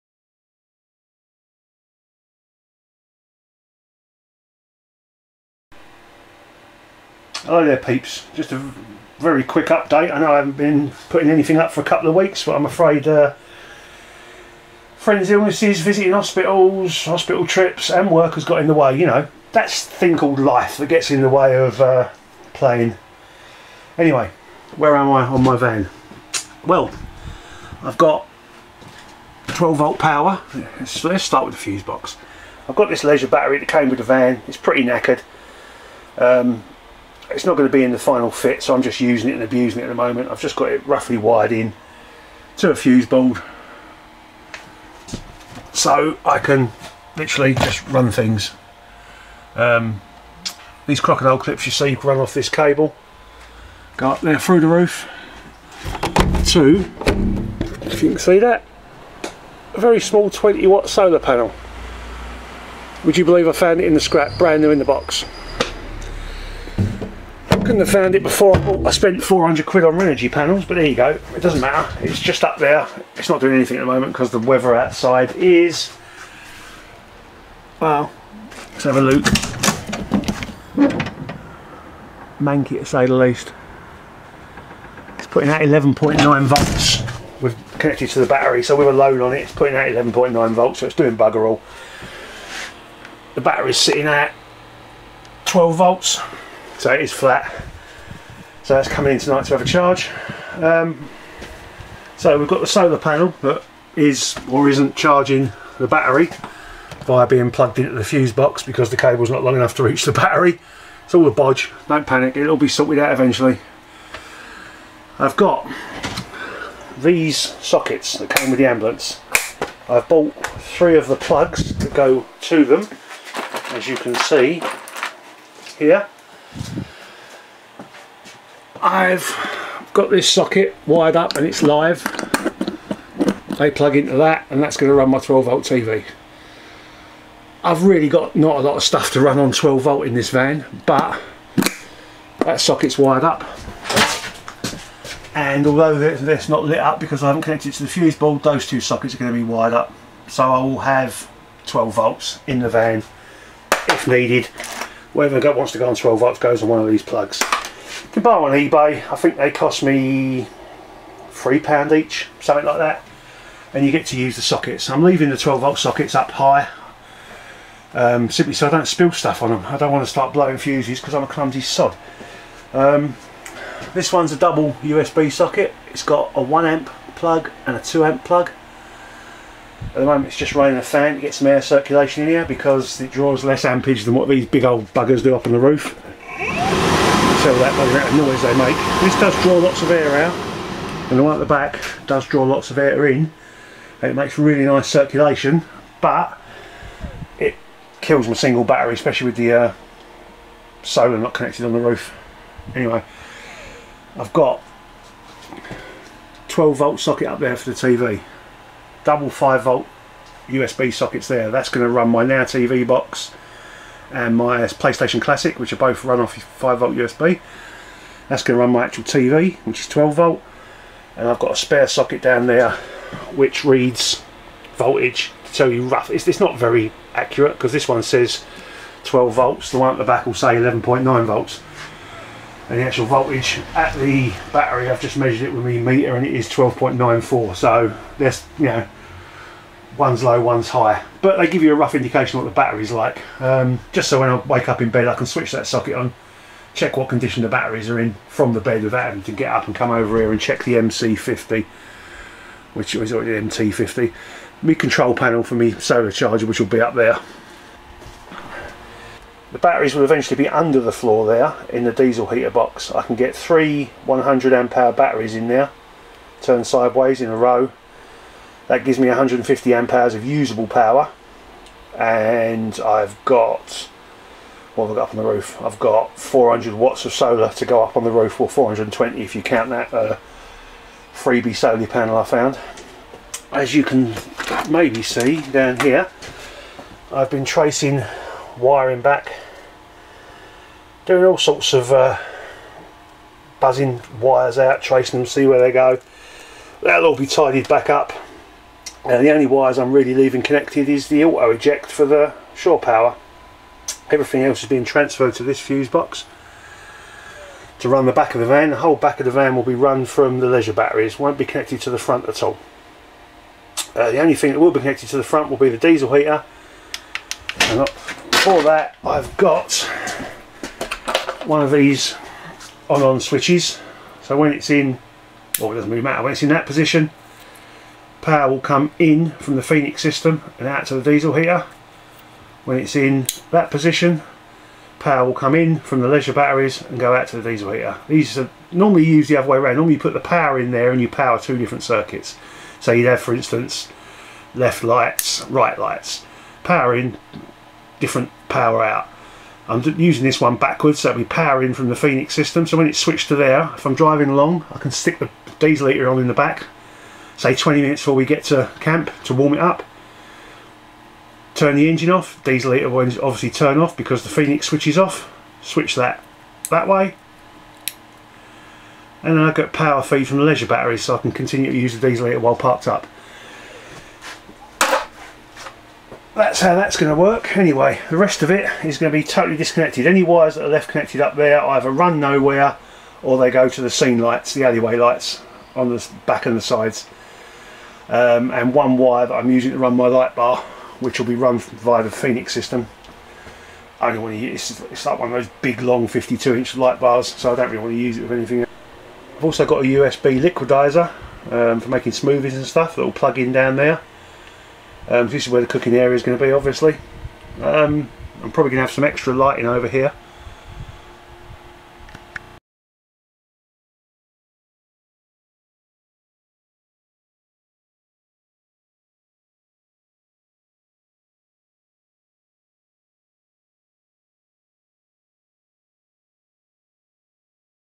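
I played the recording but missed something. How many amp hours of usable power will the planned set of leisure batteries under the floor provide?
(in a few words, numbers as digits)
150.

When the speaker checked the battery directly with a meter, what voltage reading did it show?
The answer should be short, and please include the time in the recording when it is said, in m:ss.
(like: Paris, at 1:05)
12.94, at 3:56.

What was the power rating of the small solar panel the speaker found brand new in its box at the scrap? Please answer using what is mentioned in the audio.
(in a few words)
20 watt.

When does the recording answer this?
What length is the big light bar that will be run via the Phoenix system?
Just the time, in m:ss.
6:36.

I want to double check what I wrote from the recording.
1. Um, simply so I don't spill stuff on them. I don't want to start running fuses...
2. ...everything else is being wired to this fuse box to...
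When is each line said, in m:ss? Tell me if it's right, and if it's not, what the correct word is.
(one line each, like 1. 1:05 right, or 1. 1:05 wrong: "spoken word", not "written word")
1. 2:47 wrong: "blowing", not "running"
2. 5:04 wrong: "transferred", not "wired".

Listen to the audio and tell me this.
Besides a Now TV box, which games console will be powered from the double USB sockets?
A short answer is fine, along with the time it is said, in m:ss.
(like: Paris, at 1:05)
PlayStation Classic, at 3:34.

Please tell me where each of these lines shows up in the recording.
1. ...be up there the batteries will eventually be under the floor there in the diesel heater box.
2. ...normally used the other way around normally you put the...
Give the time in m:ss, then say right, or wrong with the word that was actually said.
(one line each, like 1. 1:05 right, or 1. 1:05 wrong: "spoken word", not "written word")
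1. 4:16 right
2. 5:38 right.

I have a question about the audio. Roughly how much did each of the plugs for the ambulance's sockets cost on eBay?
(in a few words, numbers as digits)
£3.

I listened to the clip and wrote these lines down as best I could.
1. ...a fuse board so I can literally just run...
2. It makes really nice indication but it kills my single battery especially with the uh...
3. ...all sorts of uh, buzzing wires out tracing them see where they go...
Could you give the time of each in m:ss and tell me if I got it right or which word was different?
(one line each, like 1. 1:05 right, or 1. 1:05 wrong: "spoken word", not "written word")
1. 0:42 right
2. 3:14 wrong: "circulation", not "indication"
3. 4:51 right.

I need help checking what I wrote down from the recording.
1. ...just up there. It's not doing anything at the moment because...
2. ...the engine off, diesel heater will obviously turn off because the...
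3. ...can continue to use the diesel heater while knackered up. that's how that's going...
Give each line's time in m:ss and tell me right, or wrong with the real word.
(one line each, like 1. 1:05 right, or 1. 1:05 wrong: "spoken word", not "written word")
1. 1:12 right
2. 6:01 right
3. 6:11 wrong: "parked", not "knackered".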